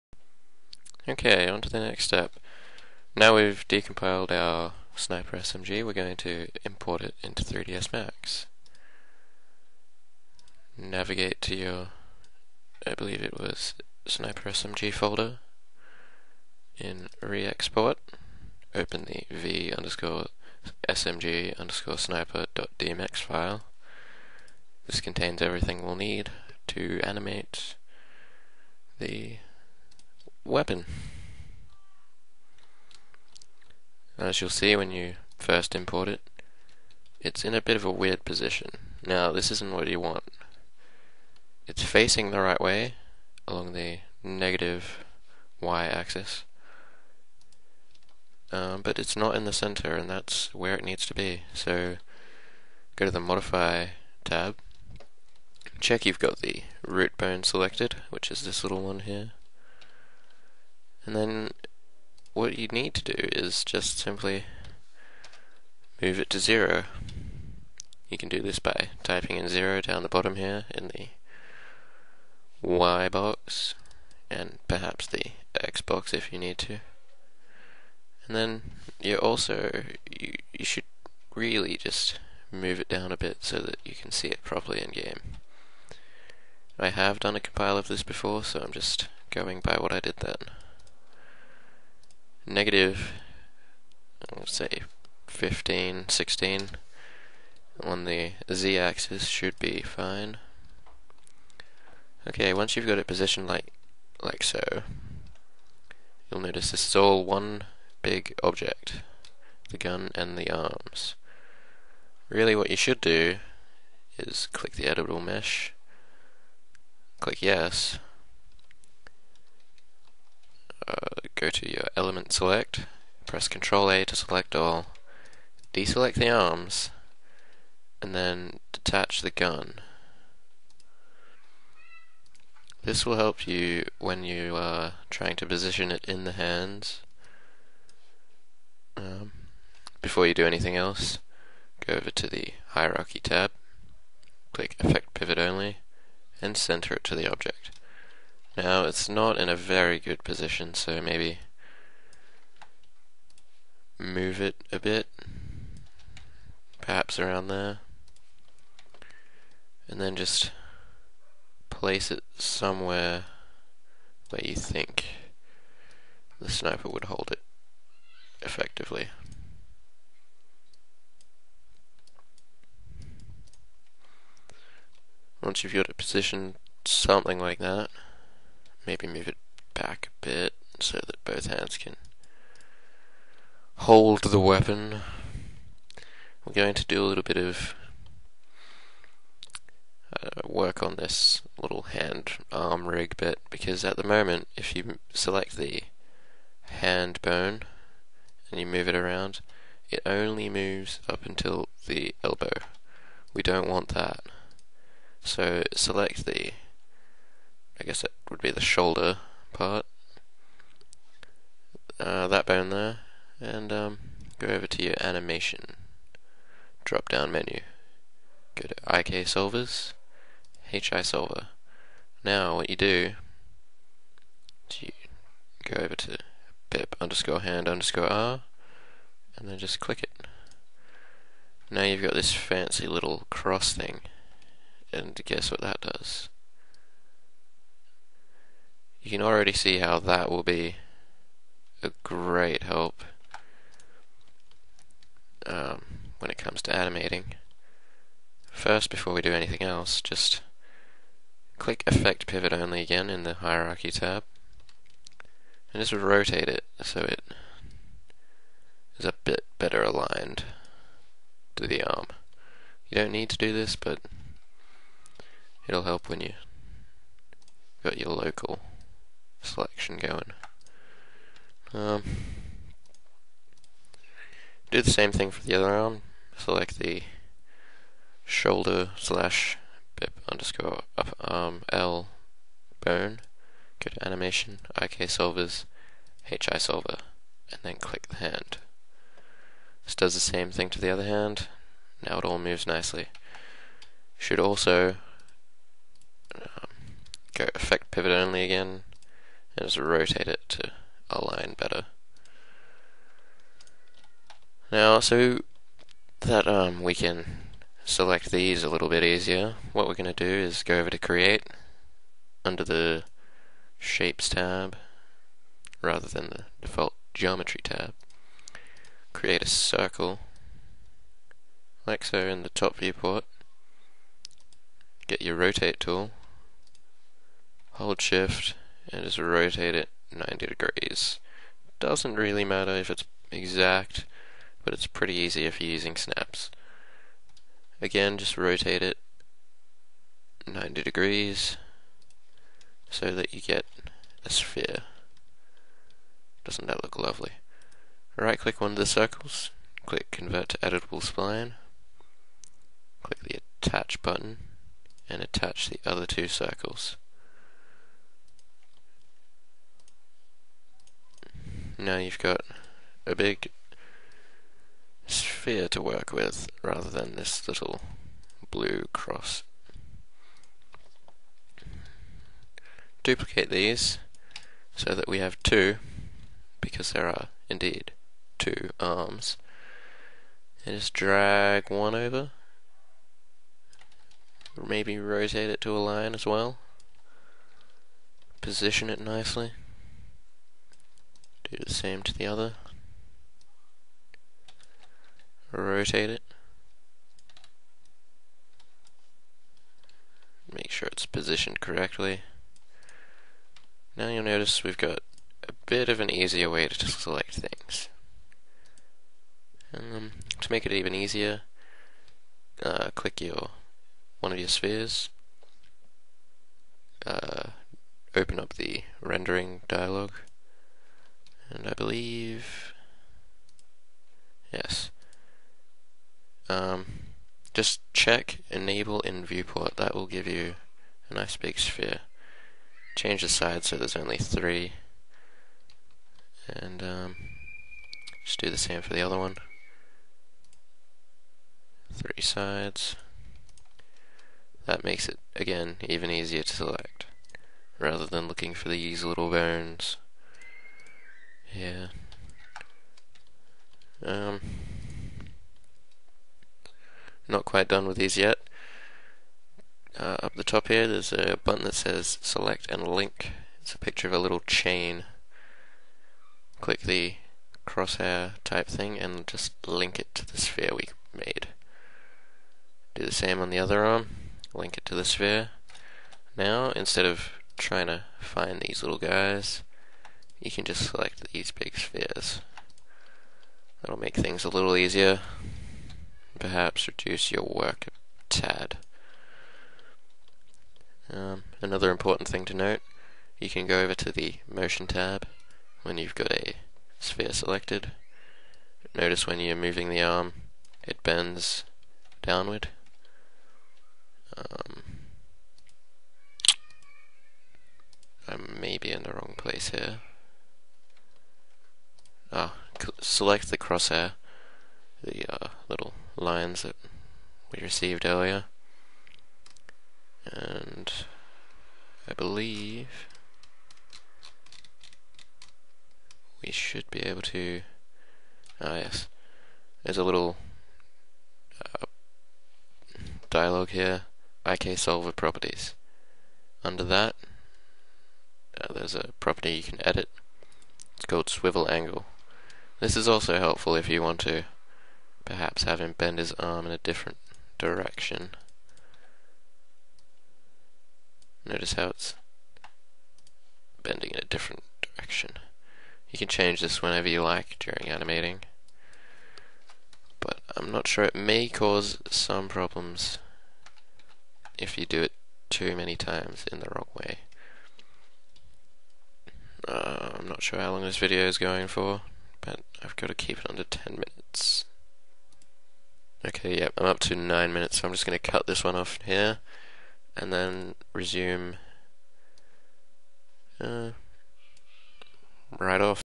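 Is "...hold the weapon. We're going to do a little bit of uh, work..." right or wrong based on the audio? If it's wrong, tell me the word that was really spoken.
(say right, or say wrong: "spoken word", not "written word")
right.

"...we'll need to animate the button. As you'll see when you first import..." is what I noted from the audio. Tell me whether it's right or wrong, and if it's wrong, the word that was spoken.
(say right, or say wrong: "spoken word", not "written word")
wrong: "weapon", not "button".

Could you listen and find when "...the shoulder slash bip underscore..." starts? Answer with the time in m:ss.
4:36.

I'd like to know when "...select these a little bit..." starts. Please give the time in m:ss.
5:07.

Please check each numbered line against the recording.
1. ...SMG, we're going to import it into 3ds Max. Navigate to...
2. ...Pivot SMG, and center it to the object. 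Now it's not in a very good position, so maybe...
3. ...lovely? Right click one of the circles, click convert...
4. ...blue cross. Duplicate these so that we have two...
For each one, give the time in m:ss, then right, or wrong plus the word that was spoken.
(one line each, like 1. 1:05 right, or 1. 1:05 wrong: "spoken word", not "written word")
1. 0:05 right
2. 2:25 wrong: "Only", not "SMG"
3. 5:46 right
4. 6:08 right.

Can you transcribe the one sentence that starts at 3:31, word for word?
Uh, that bone there, and um, go over to your animation drop down menu.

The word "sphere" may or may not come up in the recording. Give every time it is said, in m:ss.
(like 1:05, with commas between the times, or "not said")
5:44, 6:05, 6:54, 7:11, 7:50, 7:55, 8:01, 8:16.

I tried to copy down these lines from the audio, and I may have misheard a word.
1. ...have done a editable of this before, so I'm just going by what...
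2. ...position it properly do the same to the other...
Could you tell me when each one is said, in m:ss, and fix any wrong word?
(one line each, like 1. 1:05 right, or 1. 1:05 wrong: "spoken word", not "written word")
1. 1:26 wrong: "compile", not "editable"
2. 6:28 wrong: "nicely", not "properly".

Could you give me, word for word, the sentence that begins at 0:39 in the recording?
Now, this isn't what you want.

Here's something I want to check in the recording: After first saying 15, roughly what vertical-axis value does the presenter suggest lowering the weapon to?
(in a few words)
-16.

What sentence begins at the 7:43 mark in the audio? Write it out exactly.
It's a picture of a little chain.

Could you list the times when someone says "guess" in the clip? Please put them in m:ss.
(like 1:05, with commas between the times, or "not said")
3:27, 3:55.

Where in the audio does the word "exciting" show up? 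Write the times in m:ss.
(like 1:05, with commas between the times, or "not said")
not said.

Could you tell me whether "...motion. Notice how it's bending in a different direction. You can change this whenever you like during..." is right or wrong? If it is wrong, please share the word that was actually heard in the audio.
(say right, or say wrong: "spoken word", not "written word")
wrong: "direction", not "motion".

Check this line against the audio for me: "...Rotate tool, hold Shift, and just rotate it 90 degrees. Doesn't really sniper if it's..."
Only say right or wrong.
wrong.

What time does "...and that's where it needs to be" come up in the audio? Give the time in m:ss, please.
0:49.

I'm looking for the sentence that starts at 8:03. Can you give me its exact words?
That'll make things a little easier perhaps reduce your work a tad.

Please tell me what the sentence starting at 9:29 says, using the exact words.
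Uh, I'm not sure how long this video is going for, but I've got to keep it under 10 minutes.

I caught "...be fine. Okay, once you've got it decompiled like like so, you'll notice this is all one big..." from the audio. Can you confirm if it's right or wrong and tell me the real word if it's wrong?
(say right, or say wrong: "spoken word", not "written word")
wrong: "positioned", not "decompiled".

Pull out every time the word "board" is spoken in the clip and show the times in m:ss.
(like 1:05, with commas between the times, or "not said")
not said.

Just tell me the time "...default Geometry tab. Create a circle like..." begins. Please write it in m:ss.
5:16.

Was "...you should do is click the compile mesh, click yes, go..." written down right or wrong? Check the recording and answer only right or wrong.
wrong.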